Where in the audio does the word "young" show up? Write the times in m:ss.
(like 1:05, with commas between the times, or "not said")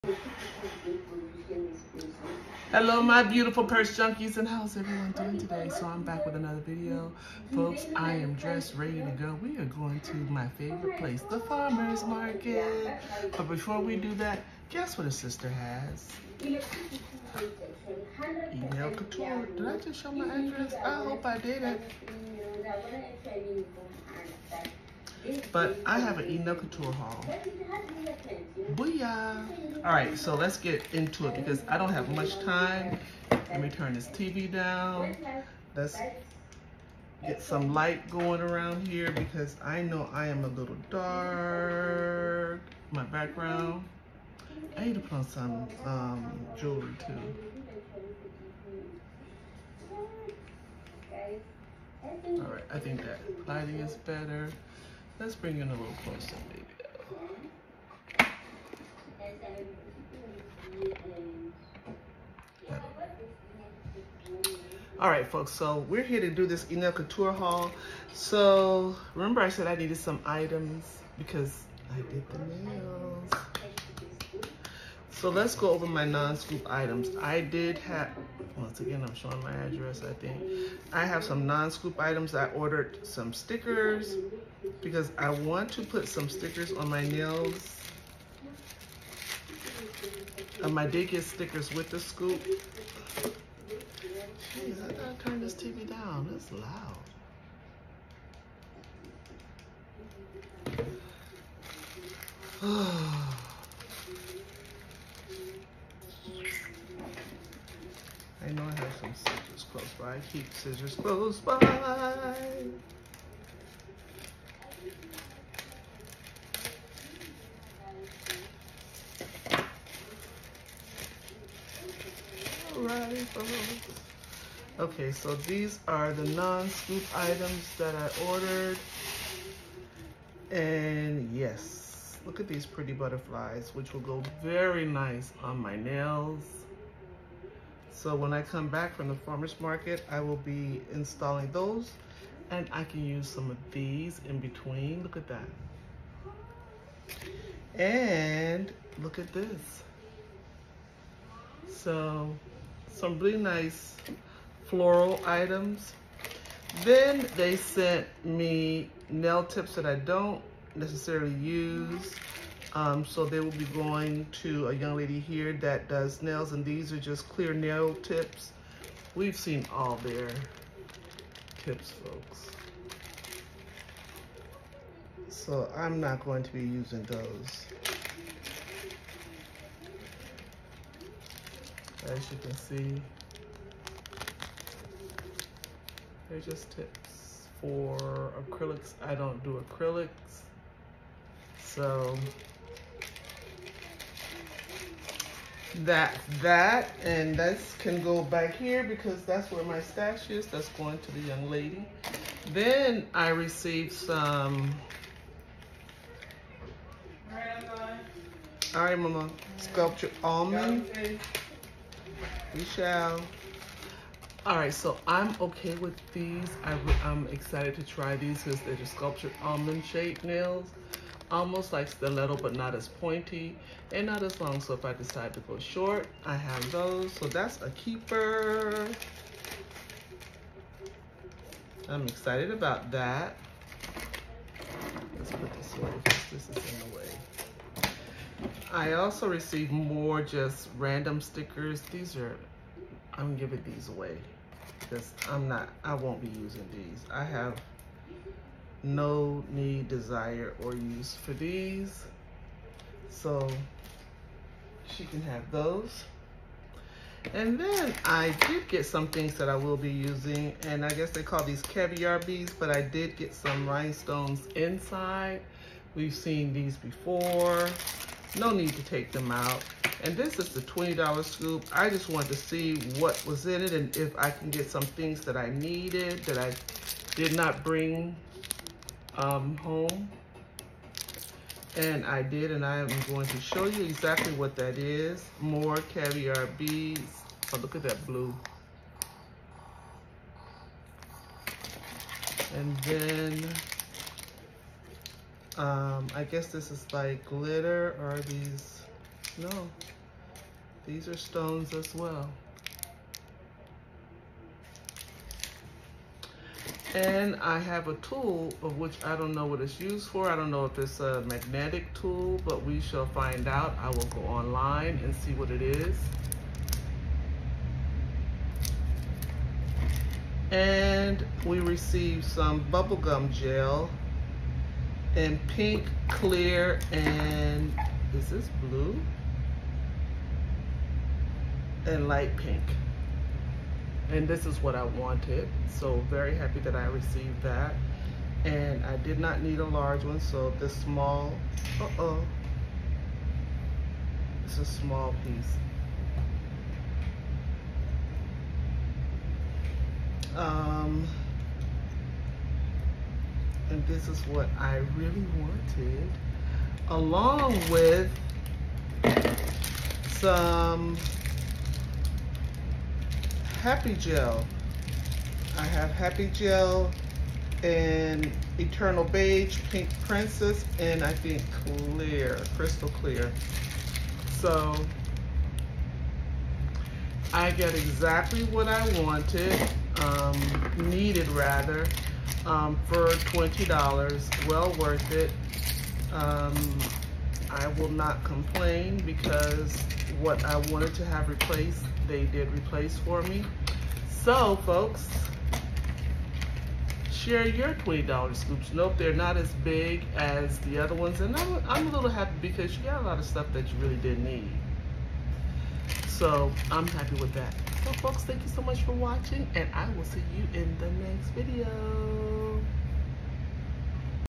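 2:44, 3:21.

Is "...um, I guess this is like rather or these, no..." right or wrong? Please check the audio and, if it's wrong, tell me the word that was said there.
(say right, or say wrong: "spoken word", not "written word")
wrong: "glitter", not "rather".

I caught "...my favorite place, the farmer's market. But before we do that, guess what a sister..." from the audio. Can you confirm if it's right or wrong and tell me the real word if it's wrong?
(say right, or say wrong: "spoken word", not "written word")
right.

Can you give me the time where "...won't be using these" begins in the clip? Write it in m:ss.
4:05.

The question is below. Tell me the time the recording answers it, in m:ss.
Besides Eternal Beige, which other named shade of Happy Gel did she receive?
6:09.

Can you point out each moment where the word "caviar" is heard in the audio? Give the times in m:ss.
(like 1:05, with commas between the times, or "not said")
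4:21, 4:45.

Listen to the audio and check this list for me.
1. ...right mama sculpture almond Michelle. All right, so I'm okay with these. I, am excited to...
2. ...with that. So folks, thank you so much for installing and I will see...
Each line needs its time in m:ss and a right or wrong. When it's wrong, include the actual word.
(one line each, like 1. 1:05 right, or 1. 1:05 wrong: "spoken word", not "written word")
1. 3:28 right
2. 6:47 wrong: "watching", not "installing".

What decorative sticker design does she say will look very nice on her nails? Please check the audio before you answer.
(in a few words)
butterflies.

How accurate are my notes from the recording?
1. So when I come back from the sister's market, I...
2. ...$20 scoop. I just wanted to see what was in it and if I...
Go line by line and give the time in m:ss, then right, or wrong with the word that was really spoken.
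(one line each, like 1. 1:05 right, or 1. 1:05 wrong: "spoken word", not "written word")
1. 2:17 wrong: "farmer", not "sister"
2. 4:30 right.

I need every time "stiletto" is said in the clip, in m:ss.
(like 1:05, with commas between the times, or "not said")
3:41.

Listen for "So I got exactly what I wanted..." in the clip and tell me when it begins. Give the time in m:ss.
6:14.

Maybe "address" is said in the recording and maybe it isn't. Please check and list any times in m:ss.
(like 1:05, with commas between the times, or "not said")
0:20, 1:19.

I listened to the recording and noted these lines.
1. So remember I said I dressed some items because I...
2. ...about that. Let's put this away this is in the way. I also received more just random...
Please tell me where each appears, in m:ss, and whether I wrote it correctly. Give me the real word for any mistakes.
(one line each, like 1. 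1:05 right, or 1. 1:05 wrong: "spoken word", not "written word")
1. 1:08 wrong: "needed", not "dressed"
2. 3:52 right.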